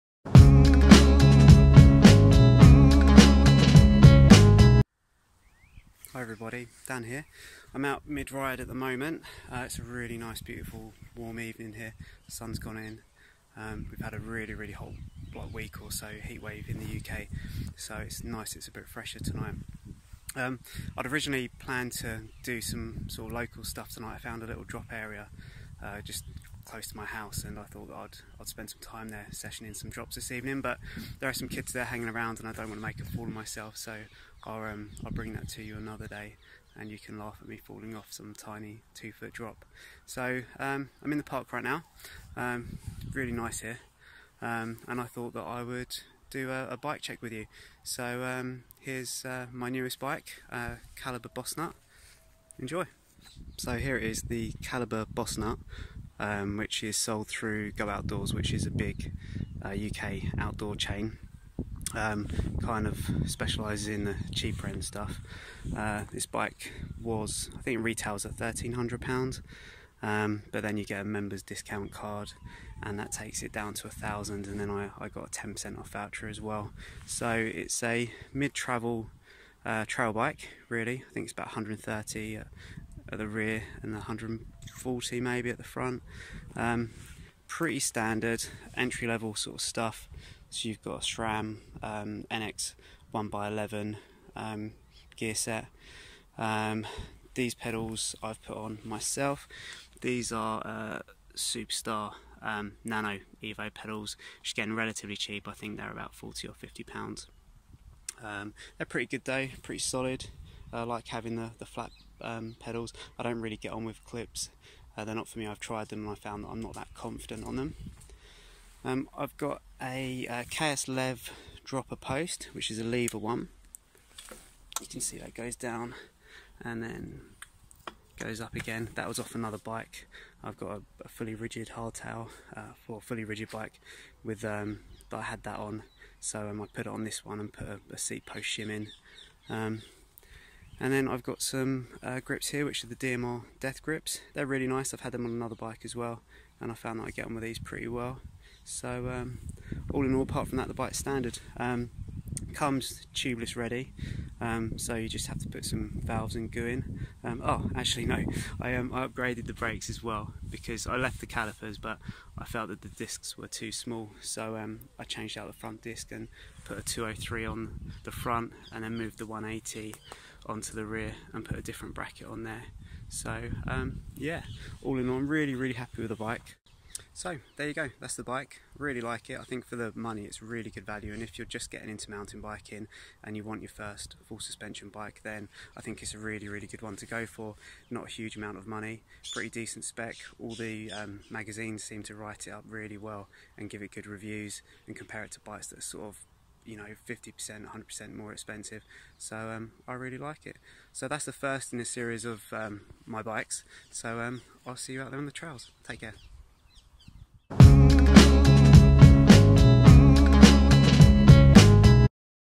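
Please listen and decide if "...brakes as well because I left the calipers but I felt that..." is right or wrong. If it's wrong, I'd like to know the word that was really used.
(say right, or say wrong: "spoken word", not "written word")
right.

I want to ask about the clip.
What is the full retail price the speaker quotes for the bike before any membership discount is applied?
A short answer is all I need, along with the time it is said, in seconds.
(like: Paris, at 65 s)
£1,300, at 68 s.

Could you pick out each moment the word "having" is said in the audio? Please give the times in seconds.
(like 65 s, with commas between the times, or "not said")
111 s.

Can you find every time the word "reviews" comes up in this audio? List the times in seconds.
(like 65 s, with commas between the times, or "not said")
194 s.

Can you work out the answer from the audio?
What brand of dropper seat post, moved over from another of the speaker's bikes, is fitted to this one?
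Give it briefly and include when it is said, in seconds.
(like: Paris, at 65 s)
KS Lev, at 120 s.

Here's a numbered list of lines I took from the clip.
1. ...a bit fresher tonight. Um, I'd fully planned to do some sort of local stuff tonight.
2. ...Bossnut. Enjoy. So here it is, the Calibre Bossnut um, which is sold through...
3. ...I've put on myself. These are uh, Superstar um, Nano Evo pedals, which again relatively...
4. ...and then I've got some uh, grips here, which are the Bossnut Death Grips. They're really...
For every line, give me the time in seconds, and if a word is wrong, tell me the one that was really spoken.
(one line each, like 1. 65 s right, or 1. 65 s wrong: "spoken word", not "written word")
1. 18 s wrong: "originally", not "fully"
2. 51 s right
3. 98 s right
4. 140 s wrong: "DMR", not "Bossnut".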